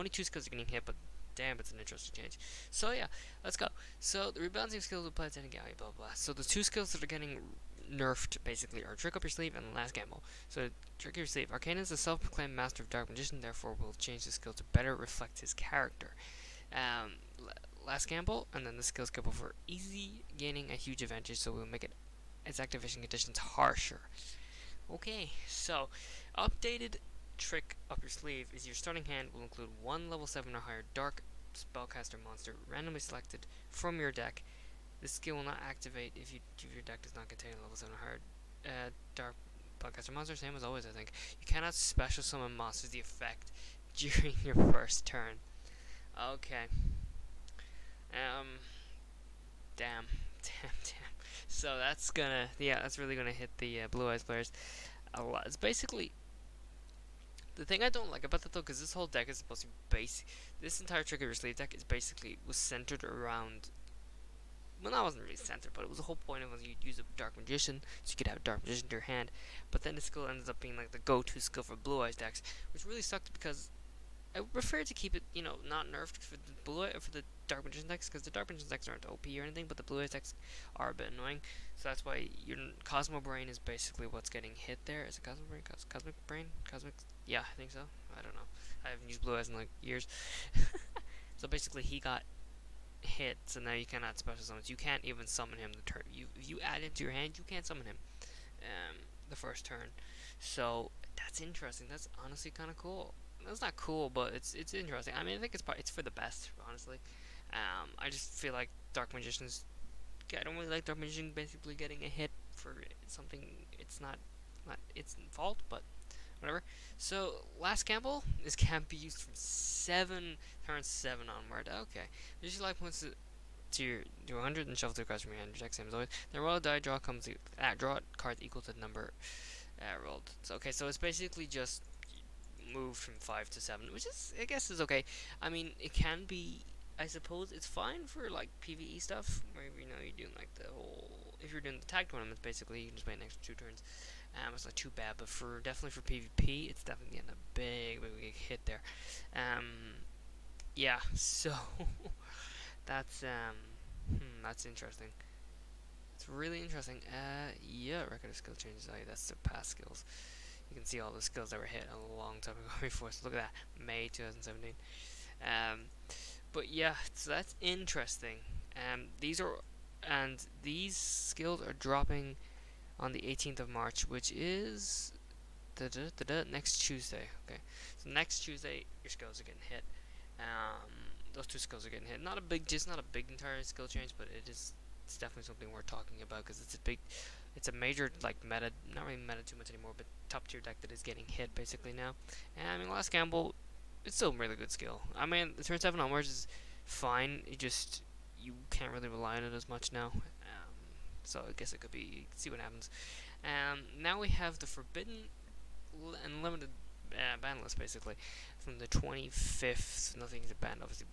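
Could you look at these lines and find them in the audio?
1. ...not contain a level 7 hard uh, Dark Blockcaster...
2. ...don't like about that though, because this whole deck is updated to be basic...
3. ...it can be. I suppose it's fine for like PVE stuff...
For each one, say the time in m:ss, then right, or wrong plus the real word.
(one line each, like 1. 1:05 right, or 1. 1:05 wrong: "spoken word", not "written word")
1. 0:37 right
2. 0:57 wrong: "supposed", not "updated"
3. 2:15 right.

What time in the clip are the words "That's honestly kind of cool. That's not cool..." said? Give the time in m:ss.
1:41.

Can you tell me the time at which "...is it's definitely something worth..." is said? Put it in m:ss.
3:04.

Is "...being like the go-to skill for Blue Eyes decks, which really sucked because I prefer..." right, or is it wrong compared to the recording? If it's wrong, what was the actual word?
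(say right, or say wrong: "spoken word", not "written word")
right.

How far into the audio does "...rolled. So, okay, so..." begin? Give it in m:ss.
2:10.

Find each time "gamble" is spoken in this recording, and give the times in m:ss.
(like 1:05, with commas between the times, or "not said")
0:09, 0:18, 1:57, 3:13.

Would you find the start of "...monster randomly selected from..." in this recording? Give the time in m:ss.
0:32.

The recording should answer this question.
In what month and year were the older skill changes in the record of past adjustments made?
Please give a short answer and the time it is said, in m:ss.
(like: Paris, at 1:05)
May 2017, at 2:43.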